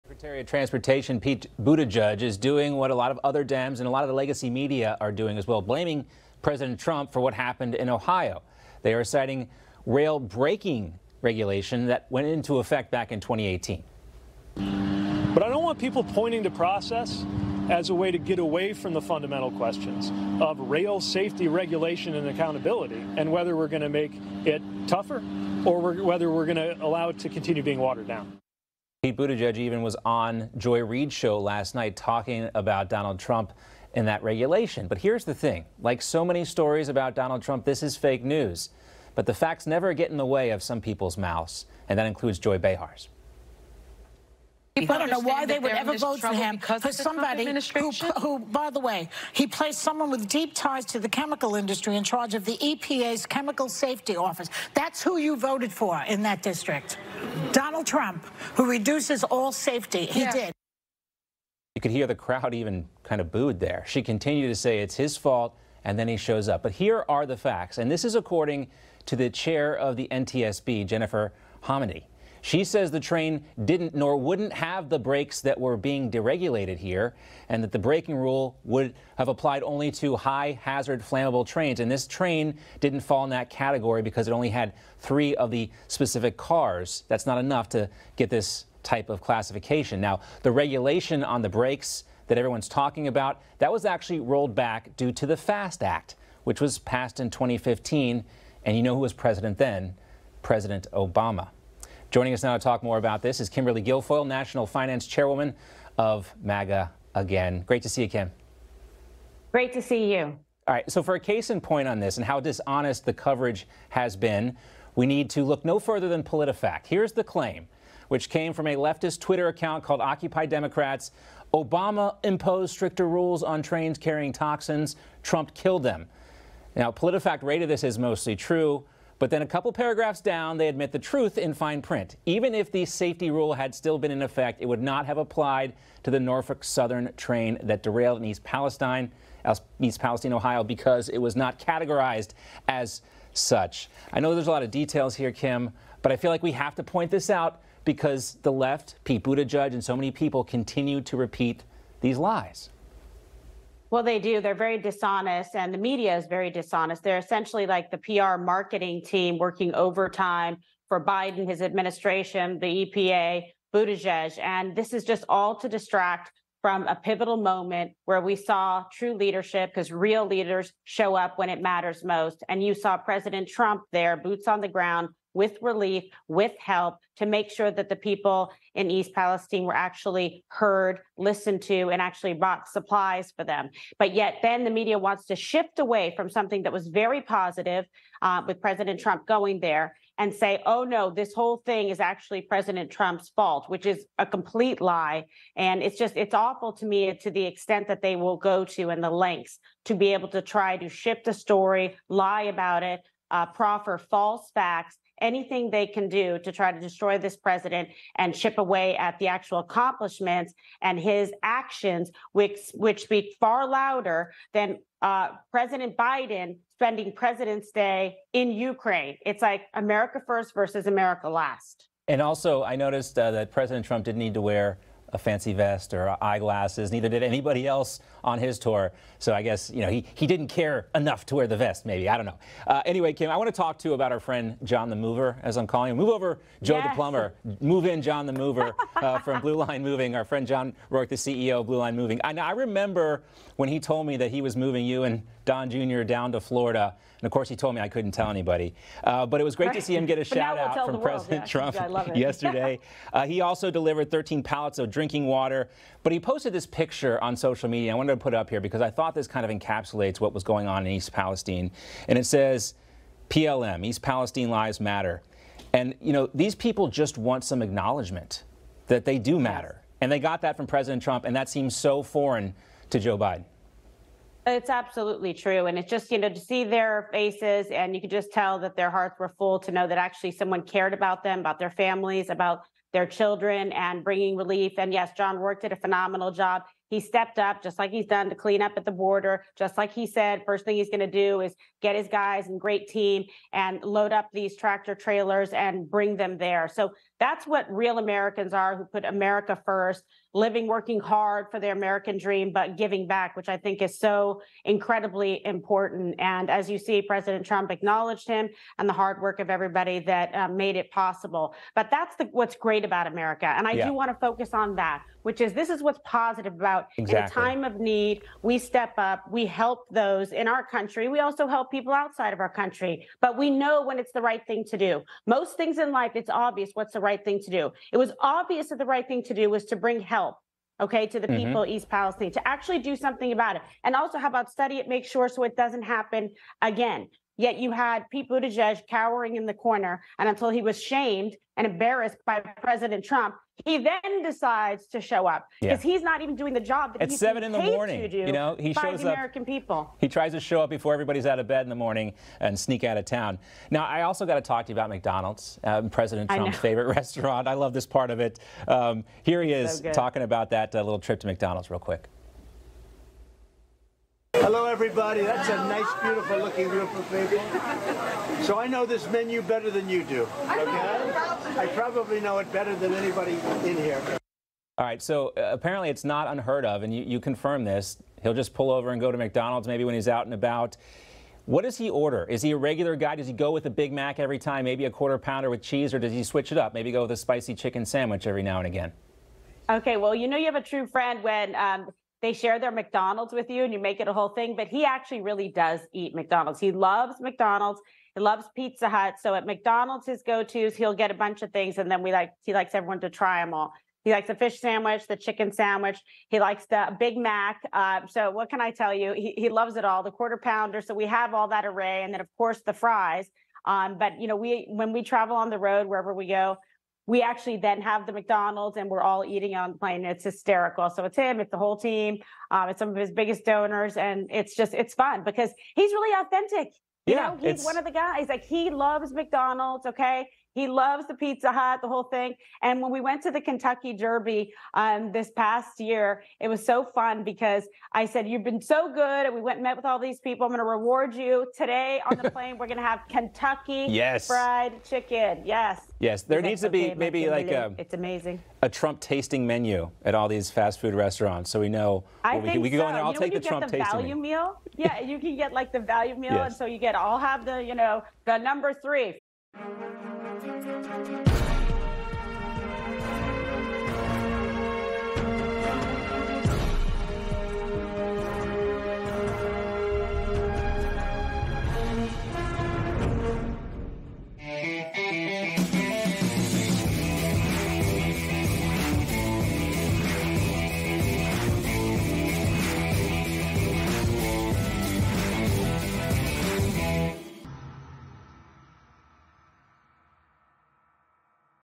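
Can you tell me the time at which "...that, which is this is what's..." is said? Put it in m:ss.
5:14.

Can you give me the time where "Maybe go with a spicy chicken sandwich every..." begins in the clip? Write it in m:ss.
6:26.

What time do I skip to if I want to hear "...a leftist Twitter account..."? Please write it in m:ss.
1:58.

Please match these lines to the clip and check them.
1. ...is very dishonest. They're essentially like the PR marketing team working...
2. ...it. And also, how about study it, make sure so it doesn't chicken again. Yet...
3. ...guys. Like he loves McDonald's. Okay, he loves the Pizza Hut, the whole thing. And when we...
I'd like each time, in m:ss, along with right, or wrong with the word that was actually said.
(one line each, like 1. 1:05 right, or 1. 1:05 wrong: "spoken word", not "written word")
1. 2:36 right
2. 5:33 wrong: "happen", not "chicken"
3. 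7:07 right.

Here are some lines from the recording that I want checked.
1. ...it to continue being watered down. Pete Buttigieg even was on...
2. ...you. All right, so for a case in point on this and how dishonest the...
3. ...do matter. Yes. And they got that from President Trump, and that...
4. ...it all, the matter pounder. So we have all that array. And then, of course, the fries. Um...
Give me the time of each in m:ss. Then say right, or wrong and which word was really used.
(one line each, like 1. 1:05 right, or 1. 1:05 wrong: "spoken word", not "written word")
1. 0:27 right
2. 1:50 right
3. 4:29 right
4. 6:49 wrong: "quarter", not "matter".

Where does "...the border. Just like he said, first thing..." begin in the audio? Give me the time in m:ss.
4:48.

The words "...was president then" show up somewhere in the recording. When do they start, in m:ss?
1:39.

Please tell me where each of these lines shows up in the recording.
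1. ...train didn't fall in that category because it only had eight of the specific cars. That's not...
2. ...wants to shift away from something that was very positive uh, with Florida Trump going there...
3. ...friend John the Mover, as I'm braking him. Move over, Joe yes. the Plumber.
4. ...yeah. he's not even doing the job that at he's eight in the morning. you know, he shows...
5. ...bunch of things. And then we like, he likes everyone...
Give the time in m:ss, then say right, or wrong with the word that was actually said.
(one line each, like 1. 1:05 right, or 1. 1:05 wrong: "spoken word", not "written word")
1. 1:22 wrong: "three", not "eight"
2. 3:04 wrong: "President", not "Florida"
3. 3:54 wrong: "calling", not "braking"
4. 5:45 wrong: "seven", not "eight"
5. 6:41 right.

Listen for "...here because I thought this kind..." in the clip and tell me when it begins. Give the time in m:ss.
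4:18.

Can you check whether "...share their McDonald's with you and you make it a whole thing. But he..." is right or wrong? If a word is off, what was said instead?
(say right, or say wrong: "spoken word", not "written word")
right.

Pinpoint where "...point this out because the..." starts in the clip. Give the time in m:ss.
2:26.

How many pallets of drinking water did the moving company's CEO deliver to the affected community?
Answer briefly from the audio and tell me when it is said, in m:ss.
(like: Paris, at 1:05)
13, at 4:14.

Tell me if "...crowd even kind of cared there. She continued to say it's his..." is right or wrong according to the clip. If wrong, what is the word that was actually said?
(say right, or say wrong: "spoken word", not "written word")
wrong: "booed", not "cared".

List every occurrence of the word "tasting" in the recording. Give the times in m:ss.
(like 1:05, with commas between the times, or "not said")
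7:28, 7:33.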